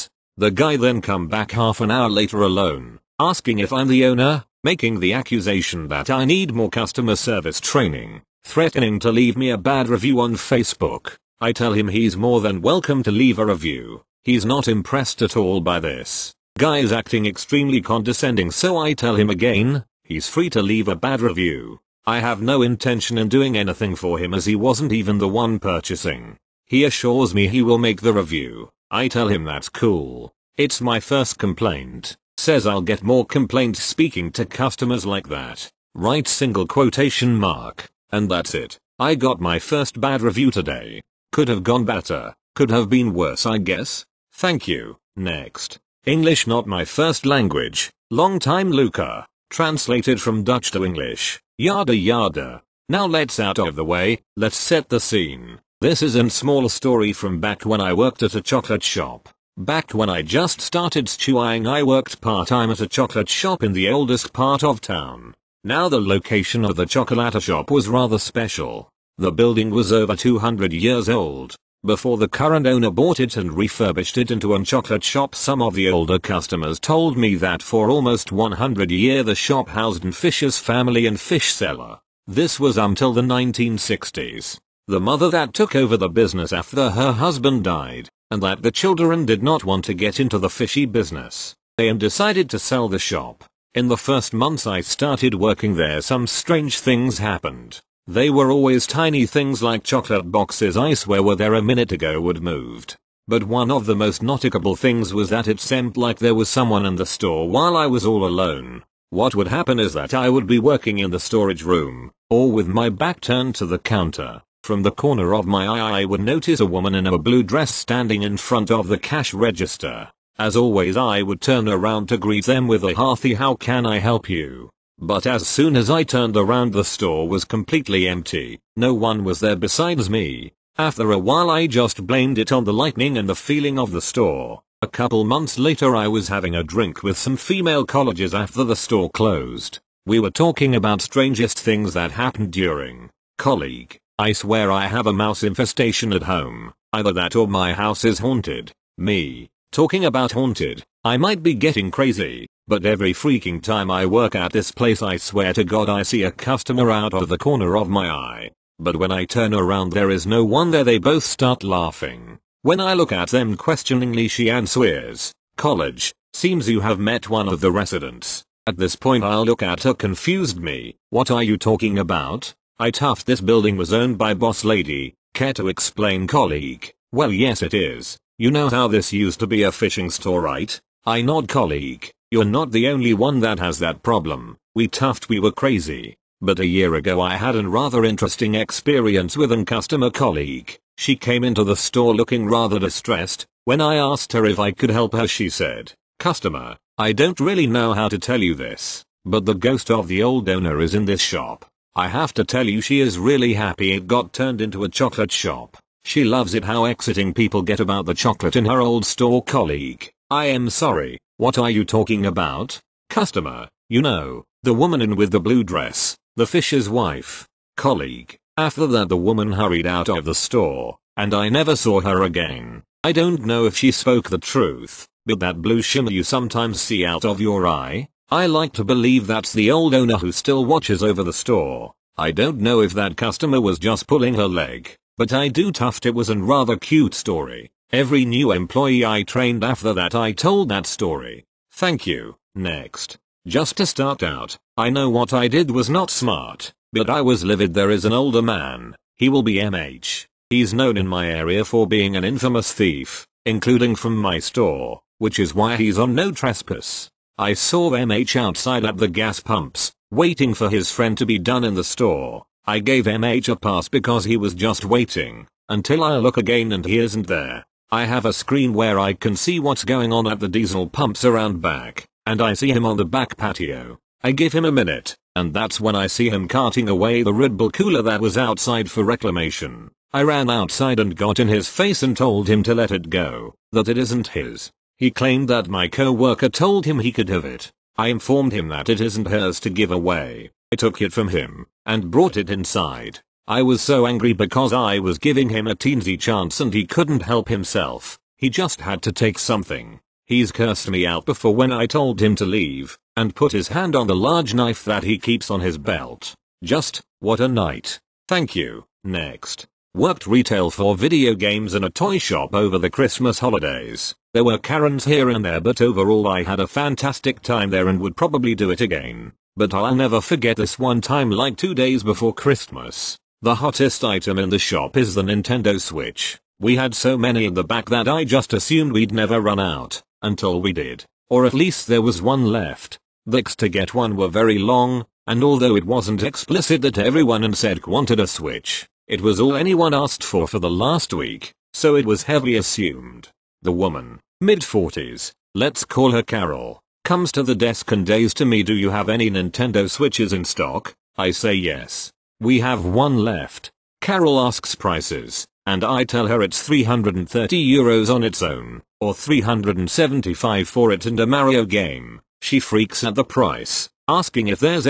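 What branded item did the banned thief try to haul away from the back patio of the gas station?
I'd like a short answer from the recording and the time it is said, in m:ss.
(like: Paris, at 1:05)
Red Bull cooler, at 4:37.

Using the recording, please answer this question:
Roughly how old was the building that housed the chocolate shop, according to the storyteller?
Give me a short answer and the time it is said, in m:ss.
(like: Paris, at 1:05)
over 200 years, at 1:09.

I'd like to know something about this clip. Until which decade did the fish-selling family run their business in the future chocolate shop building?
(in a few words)
1960s.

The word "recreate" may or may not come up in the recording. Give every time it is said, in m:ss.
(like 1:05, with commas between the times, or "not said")
not said.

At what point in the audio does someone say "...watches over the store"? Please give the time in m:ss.
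3:50.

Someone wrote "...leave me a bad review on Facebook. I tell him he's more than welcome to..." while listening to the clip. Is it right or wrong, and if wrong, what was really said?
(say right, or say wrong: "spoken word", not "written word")
right.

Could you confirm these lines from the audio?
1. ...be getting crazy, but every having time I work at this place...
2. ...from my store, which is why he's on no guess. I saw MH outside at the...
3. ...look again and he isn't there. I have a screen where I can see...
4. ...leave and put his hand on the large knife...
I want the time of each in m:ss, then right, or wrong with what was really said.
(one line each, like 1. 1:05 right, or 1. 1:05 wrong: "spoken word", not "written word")
1. 2:31 wrong: "freaking", not "having"
2. 4:13 wrong: "trespass", not "guess"
3. 4:26 right
4. 5:02 right.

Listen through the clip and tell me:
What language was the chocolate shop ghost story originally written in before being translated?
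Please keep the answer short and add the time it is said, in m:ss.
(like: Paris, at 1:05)
Dutch, at 0:50.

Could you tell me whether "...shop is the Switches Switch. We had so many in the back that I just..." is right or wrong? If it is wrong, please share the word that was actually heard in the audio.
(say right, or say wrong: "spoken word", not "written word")
wrong: "Nintendo", not "Switches".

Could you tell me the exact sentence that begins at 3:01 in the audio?
I nod colleague, you're not the only one that has that problem, we toughed we were crazy.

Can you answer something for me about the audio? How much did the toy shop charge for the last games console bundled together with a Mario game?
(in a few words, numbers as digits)
375 euros.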